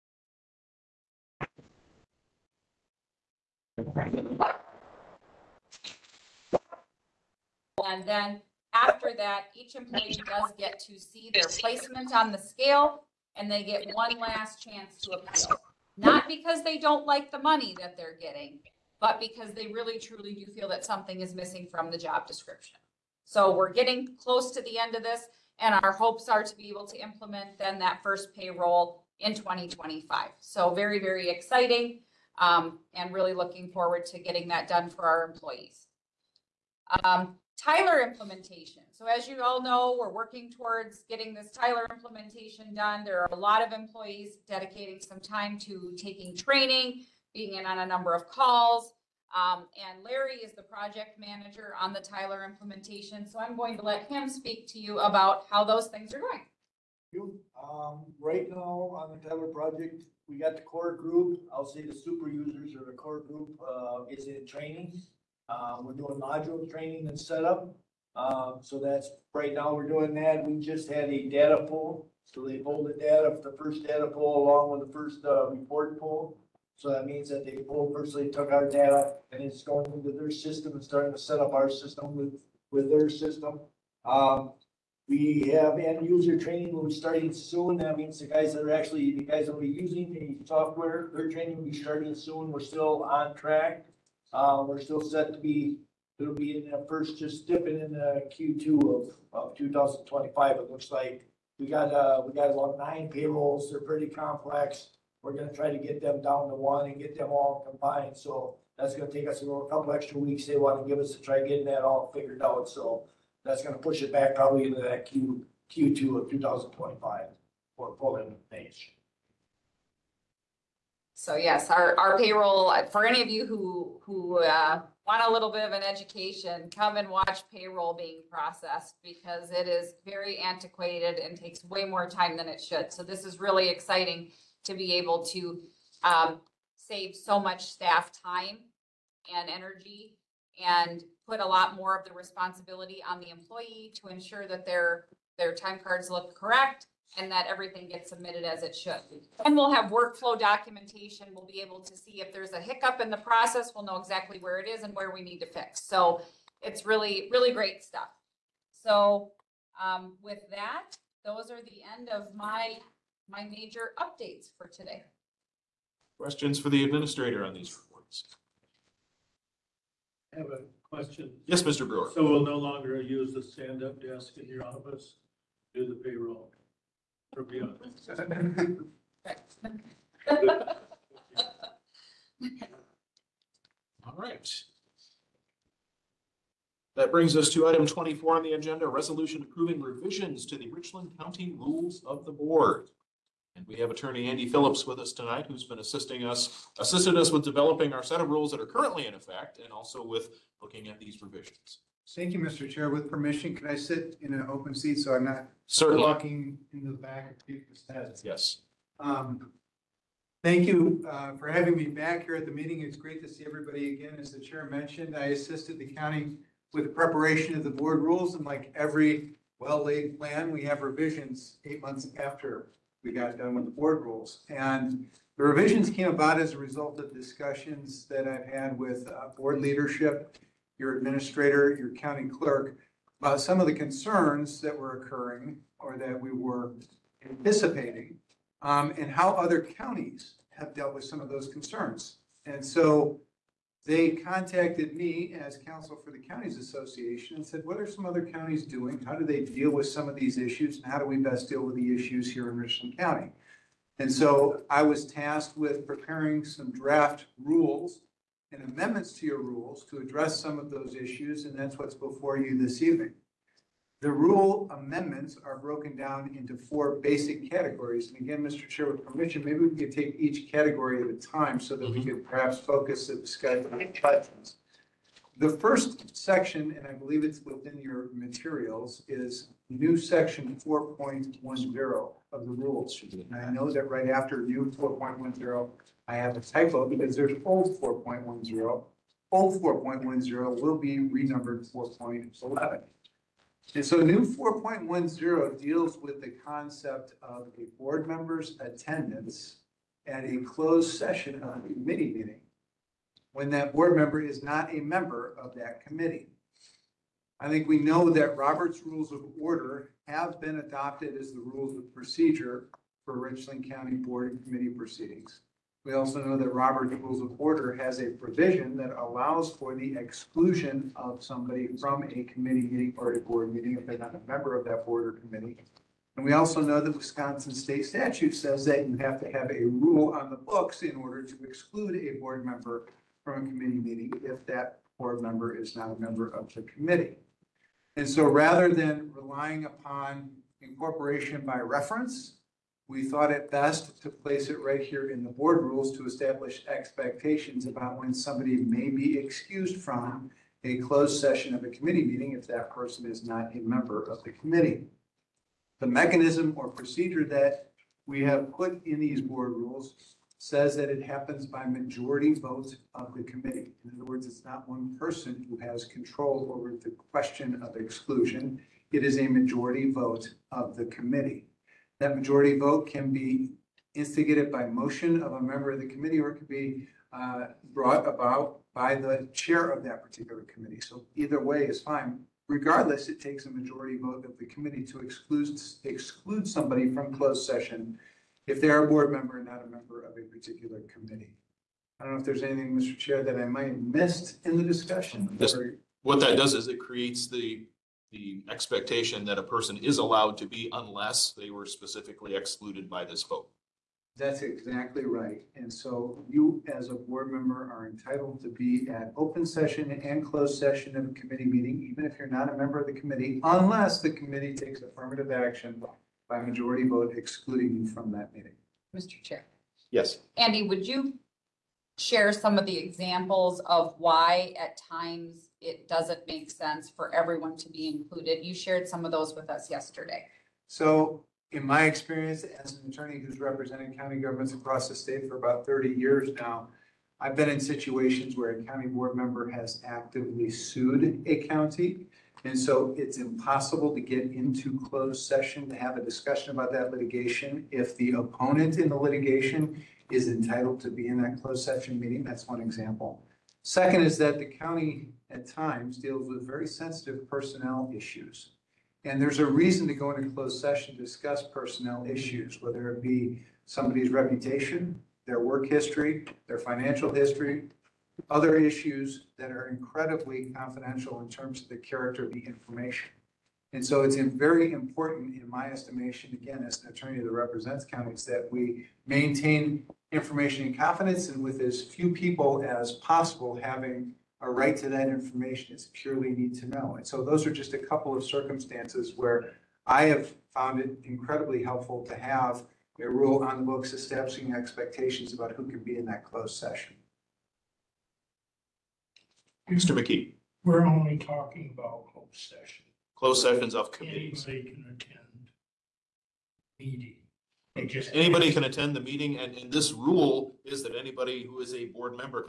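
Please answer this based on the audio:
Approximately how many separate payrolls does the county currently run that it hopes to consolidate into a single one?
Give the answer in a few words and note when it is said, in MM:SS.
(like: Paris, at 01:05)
9, at 01:42.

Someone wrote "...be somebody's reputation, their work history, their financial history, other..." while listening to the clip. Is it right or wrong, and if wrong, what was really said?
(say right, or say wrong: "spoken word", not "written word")
right.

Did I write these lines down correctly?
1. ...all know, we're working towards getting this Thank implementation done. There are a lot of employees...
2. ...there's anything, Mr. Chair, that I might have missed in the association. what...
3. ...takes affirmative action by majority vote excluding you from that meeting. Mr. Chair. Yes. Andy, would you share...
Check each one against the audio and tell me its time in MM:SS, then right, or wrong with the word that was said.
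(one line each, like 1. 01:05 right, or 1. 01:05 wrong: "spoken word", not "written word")
1. 00:39 wrong: "Tyler", not "Thank"
2. 06:32 wrong: "discussion", not "association"
3. 06:54 right.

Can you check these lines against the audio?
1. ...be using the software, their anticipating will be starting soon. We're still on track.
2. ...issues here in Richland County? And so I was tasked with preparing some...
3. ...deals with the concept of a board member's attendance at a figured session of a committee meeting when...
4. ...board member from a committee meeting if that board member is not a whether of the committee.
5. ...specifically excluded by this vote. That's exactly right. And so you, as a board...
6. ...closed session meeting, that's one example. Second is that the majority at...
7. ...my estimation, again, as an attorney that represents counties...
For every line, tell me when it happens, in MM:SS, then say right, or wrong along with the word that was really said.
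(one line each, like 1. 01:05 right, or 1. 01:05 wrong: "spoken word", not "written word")
1. 01:29 wrong: "training", not "anticipating"
2. 04:11 right
3. 04:55 wrong: "closed", not "figured"
4. 05:32 wrong: "member", not "whether"
5. 06:41 right
6. 07:31 wrong: "county", not "majority"
7. 07:55 right.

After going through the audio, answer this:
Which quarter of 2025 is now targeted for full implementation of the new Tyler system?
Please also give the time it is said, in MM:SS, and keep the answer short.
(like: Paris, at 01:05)
Q2, at 01:55.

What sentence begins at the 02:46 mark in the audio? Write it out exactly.
Questions for the administrator on these reports?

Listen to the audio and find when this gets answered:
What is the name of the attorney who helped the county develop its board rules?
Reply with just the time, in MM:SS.
03:14.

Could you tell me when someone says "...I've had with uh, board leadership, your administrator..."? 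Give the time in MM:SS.
03:48.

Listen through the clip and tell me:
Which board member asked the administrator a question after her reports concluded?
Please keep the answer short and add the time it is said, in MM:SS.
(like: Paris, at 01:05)
Mr. Brewer, at 02:51.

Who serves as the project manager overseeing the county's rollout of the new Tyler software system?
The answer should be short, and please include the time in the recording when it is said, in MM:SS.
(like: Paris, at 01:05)
Larry, at 00:50.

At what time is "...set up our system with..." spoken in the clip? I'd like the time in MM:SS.
01:21.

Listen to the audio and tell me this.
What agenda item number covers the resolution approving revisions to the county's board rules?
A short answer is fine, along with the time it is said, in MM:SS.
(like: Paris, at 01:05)
24, at 03:07.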